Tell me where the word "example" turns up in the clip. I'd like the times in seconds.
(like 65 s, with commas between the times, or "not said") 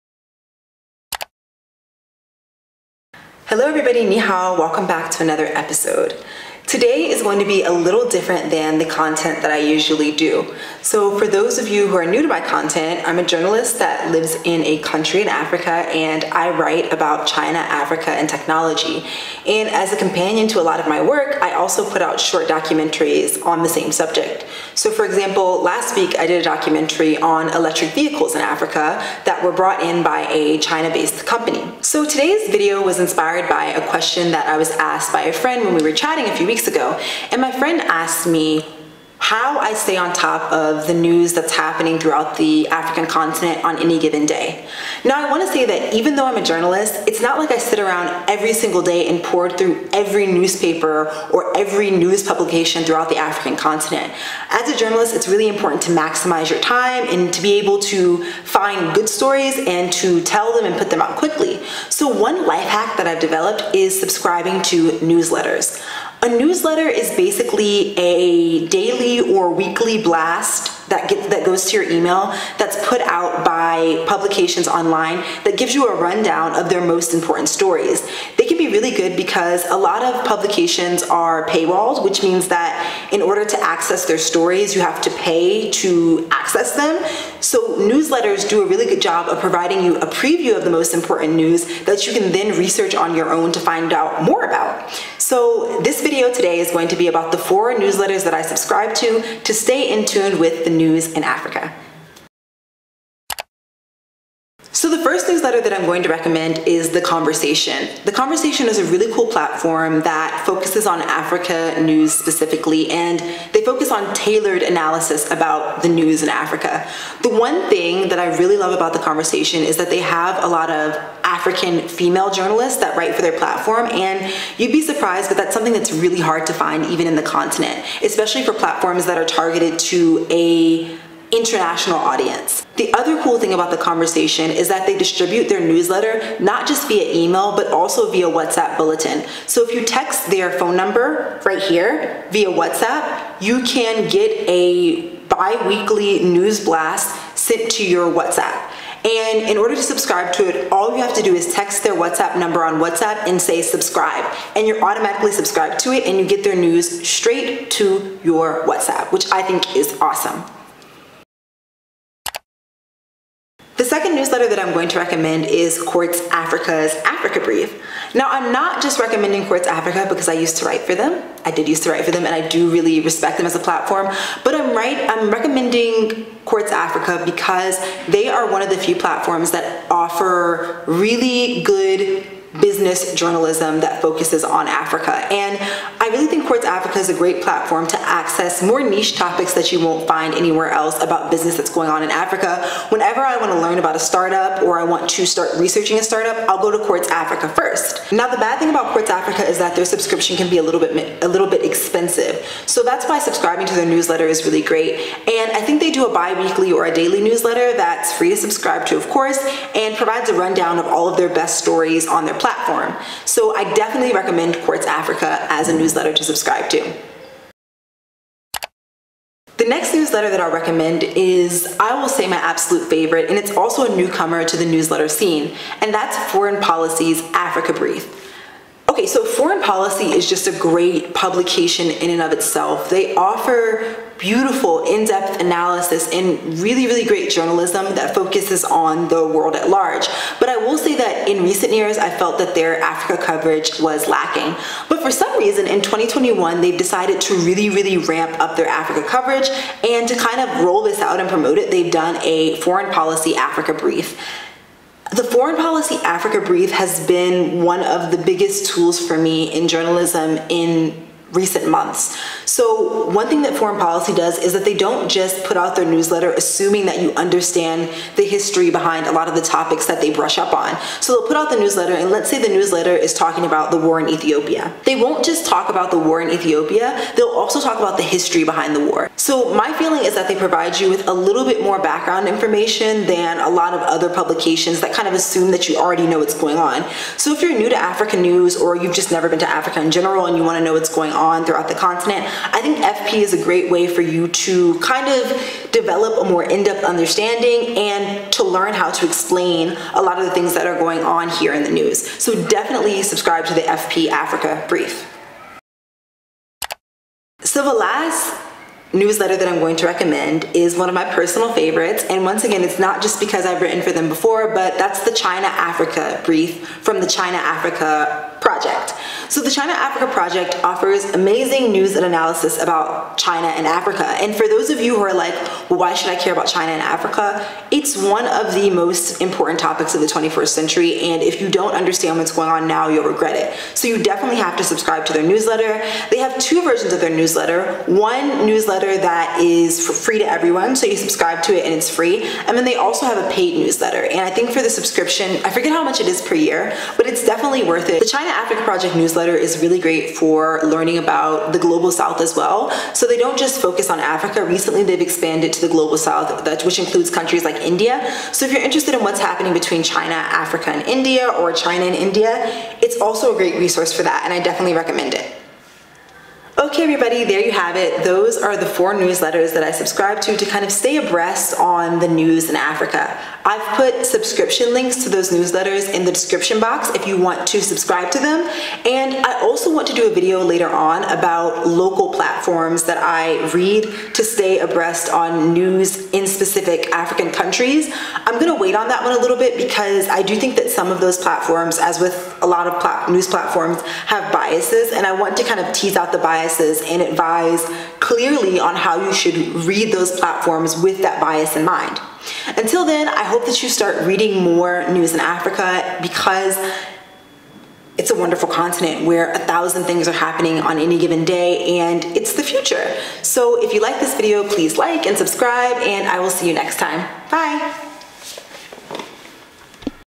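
25 s.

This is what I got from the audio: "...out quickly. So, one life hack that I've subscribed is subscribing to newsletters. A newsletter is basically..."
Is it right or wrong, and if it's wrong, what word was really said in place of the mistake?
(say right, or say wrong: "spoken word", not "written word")
wrong: "developed", not "subscribed".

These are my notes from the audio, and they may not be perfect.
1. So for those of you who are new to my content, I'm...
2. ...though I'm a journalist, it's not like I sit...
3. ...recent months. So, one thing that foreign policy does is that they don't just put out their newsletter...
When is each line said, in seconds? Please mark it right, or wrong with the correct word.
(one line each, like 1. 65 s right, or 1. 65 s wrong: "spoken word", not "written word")
1. 10 s right
2. 46 s right
3. 261 s right.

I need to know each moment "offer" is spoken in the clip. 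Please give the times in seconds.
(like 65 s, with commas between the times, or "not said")
179 s, 233 s, 320 s.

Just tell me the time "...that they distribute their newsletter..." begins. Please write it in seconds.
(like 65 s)
134 s.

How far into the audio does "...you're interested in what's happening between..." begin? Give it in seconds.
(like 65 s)
358 s.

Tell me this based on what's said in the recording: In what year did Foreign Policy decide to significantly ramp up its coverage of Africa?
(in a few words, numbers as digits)
2021.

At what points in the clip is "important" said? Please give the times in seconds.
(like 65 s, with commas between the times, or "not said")
55 s, 77 s, 90 s, 329 s.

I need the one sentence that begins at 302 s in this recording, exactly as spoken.
So definitely subscribe to the FP Africa Brief.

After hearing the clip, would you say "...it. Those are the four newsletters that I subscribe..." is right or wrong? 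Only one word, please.
right.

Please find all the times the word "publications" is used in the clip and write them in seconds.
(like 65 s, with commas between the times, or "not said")
52 s, 74 s, 80 s, 231 s, 284 s.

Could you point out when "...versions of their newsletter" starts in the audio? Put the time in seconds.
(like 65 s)
336 s.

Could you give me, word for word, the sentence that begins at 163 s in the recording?
The second newsletter that I'm going to recommend is Quartz Africa's Africa Brief.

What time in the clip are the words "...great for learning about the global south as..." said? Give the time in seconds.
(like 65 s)
349 s.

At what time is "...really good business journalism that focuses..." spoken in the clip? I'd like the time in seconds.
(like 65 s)
180 s.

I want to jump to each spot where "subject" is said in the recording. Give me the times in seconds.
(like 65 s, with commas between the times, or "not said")
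23 s.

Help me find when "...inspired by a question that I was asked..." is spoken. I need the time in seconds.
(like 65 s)
33 s.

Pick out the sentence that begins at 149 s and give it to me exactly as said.
And in order to subscribe to it, all you have to do is text their WhatsApp number on WhatsApp and say subscribe.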